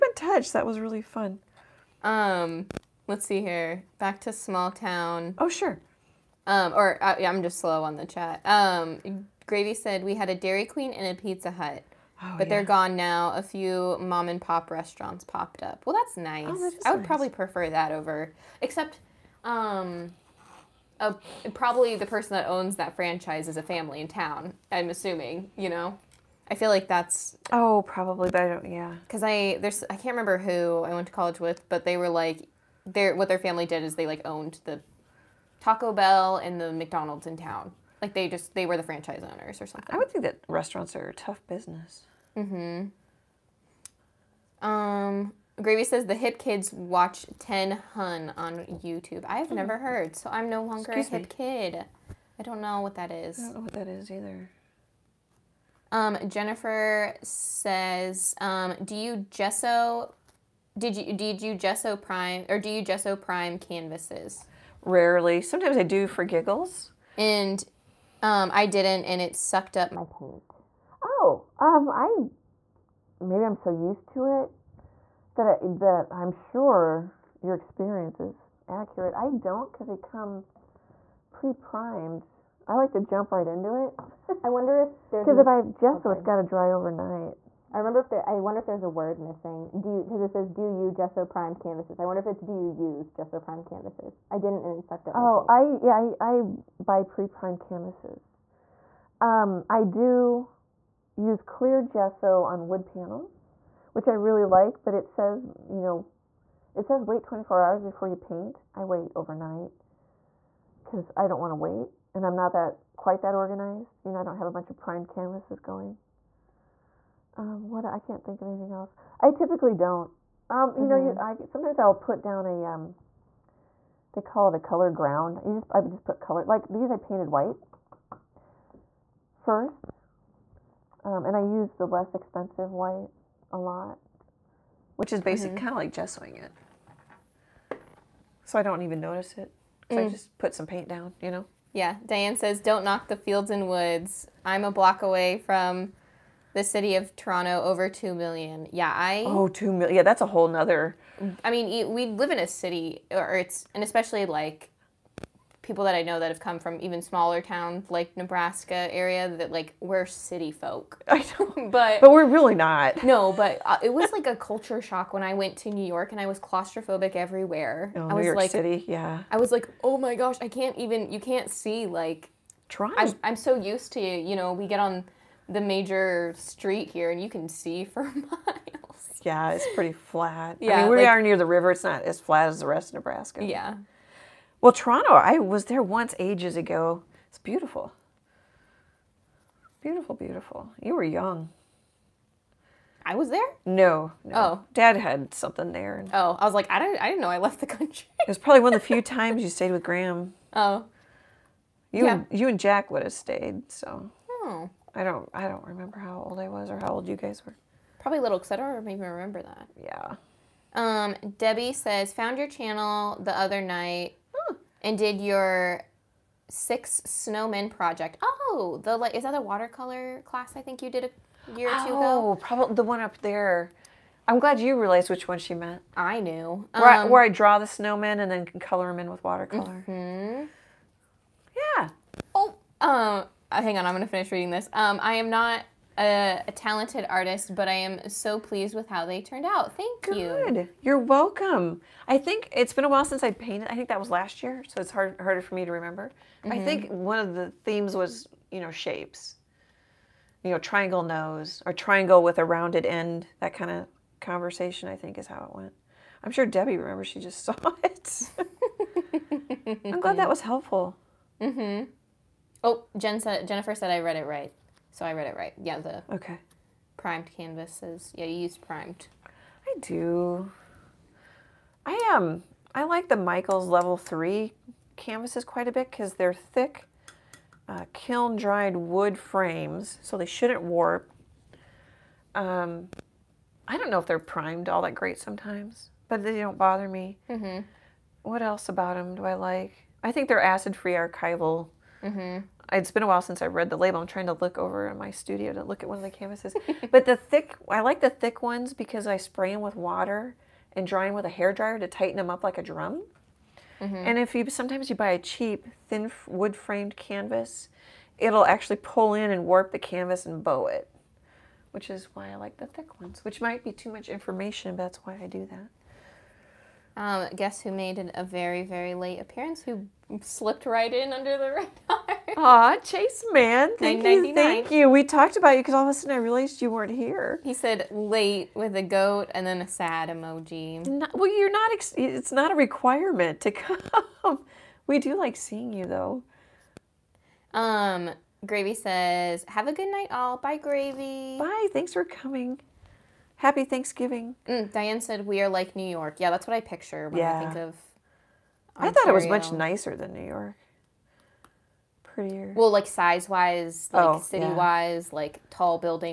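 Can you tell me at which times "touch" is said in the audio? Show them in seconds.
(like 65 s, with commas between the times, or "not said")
0 s.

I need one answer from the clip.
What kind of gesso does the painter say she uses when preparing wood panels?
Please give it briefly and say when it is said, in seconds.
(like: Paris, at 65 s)
Clear gesso, at 101 s.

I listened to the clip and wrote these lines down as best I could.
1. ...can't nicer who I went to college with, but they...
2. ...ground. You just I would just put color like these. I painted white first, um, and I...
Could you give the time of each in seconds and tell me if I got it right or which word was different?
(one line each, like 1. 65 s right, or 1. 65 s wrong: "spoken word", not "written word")
1. 29 s wrong: "remember", not "nicer"
2. 124 s right.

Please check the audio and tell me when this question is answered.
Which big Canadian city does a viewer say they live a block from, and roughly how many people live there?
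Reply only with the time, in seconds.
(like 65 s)
147 s.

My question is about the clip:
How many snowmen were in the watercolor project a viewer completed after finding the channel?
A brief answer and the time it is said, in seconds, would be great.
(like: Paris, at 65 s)
6, at 216 s.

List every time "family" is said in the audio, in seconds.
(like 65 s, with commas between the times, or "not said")
23 s, 33 s.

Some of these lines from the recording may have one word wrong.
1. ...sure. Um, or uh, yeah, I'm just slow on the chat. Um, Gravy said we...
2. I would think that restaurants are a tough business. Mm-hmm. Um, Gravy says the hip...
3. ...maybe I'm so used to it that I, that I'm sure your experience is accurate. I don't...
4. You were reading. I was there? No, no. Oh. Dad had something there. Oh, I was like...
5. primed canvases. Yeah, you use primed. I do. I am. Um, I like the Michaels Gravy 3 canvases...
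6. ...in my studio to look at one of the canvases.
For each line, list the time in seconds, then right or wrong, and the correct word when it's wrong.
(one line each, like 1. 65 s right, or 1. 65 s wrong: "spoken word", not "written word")
1. 5 s right
2. 39 s right
3. 73 s right
4. 190 s wrong: "young", not "reading"
5. 266 s wrong: "Level", not "Gravy"
6. 294 s right.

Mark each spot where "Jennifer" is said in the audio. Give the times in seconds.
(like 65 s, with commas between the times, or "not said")
56 s, 263 s.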